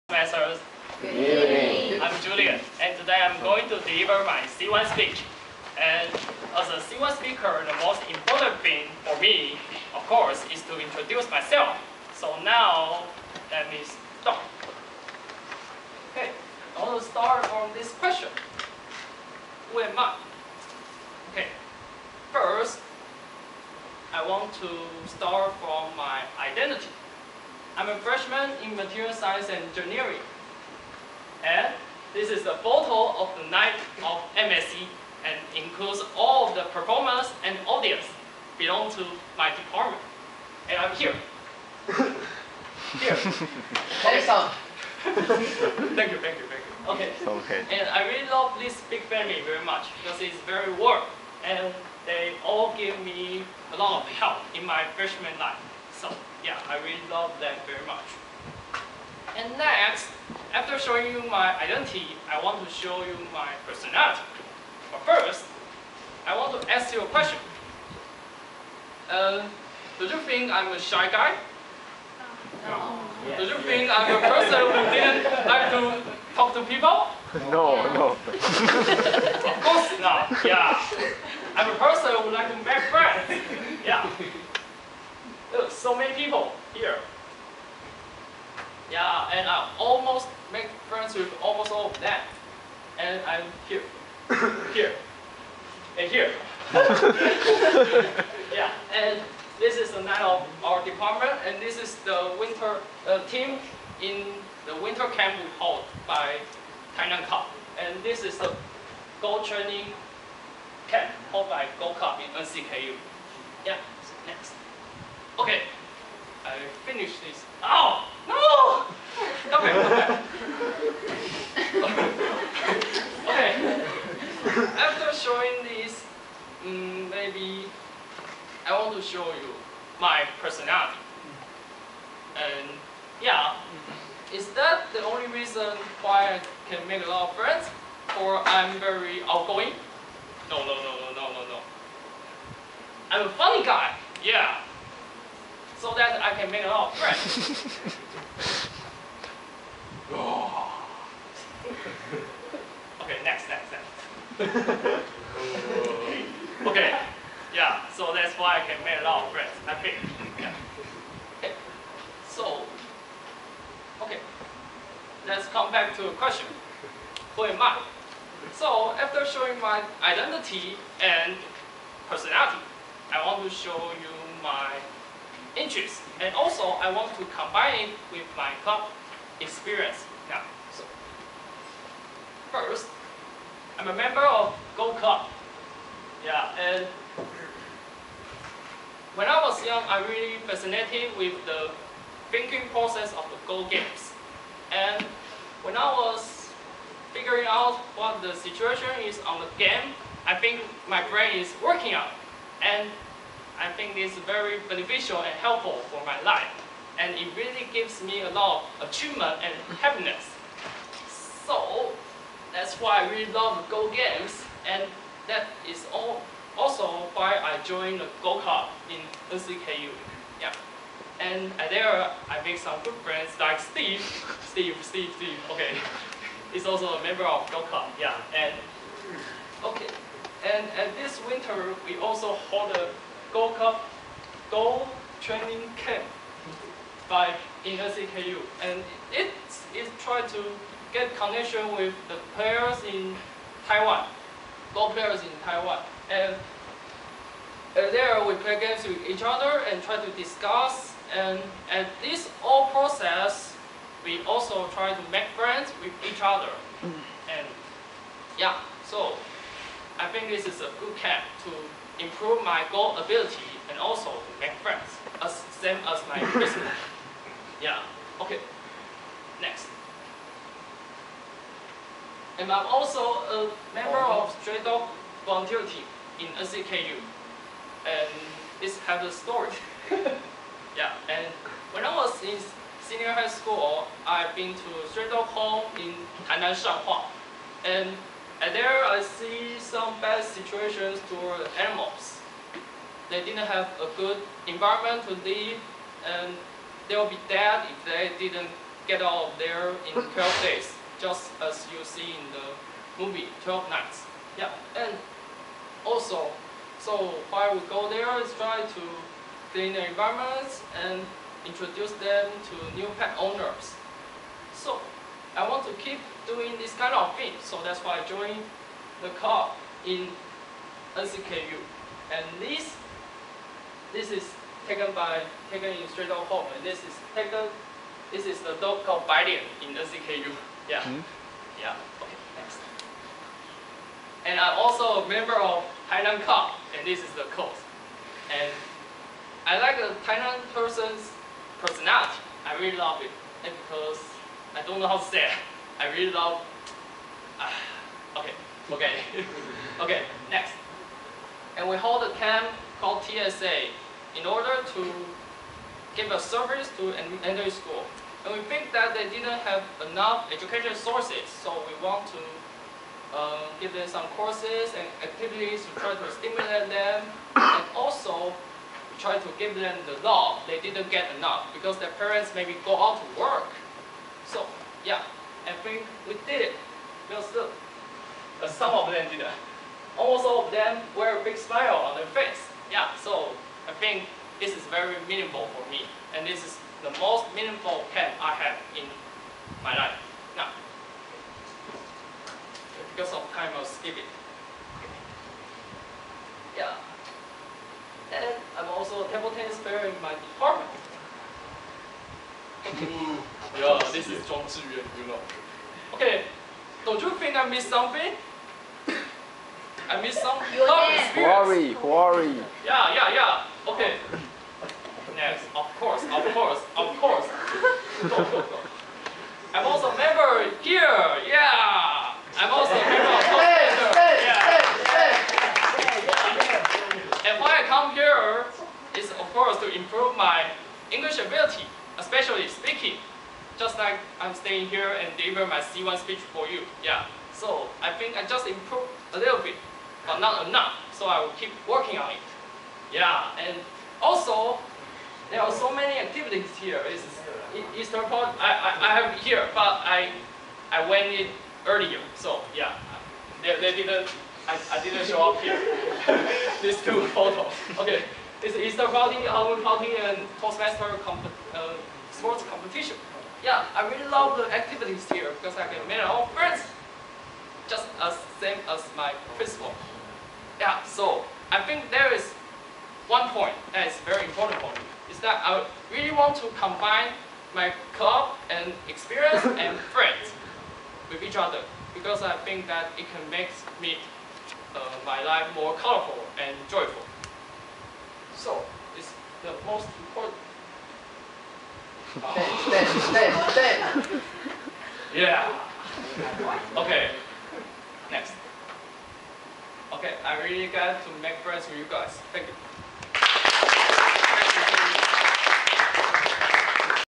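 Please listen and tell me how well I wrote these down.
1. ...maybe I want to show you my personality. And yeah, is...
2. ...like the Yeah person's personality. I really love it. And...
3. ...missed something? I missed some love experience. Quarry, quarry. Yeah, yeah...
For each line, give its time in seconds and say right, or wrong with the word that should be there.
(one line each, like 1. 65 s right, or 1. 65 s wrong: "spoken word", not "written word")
1. 127 s right
2. 339 s wrong: "Tainan", not "Yeah"
3. 407 s right.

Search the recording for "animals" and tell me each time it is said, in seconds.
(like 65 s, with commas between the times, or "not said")
291 s.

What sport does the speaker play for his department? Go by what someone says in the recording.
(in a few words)
Table tennis.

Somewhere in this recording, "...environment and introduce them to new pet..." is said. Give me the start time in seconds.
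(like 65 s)
309 s.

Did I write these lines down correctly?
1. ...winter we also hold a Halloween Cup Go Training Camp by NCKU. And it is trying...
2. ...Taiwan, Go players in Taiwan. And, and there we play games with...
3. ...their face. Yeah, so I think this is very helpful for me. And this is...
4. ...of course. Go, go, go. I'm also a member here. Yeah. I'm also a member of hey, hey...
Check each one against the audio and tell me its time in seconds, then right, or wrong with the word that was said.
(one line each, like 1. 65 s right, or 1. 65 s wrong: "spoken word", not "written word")
1. 231 s wrong: "Gold", not "Halloween"
2. 243 s right
3. 381 s wrong: "meaningful", not "helpful"
4. 416 s right.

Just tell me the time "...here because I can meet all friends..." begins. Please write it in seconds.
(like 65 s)
465 s.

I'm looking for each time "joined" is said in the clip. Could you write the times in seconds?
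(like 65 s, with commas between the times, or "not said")
217 s, 318 s.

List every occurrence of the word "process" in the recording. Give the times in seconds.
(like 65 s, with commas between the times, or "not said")
192 s, 252 s.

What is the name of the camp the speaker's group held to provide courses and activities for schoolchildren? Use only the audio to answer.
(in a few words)
TSA.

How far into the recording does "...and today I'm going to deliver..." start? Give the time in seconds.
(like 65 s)
2 s.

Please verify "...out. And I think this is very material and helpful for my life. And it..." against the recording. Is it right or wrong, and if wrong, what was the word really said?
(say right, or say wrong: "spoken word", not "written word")
wrong: "beneficial", not "material".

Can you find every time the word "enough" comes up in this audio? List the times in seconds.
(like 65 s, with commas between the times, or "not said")
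359 s, 371 s, 440 s.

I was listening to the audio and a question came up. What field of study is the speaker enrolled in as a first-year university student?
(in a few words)
Material science and engineering.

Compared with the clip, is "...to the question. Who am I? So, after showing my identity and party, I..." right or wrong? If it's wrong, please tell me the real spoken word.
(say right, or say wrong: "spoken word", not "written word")
wrong: "personality", not "party".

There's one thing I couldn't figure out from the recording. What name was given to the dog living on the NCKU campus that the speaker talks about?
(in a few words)
Biden.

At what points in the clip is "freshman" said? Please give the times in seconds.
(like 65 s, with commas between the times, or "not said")
27 s, 54 s.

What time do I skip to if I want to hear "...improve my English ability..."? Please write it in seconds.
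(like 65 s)
429 s.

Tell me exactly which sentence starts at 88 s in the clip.
Yeah, and I almost make friends with almost all of them.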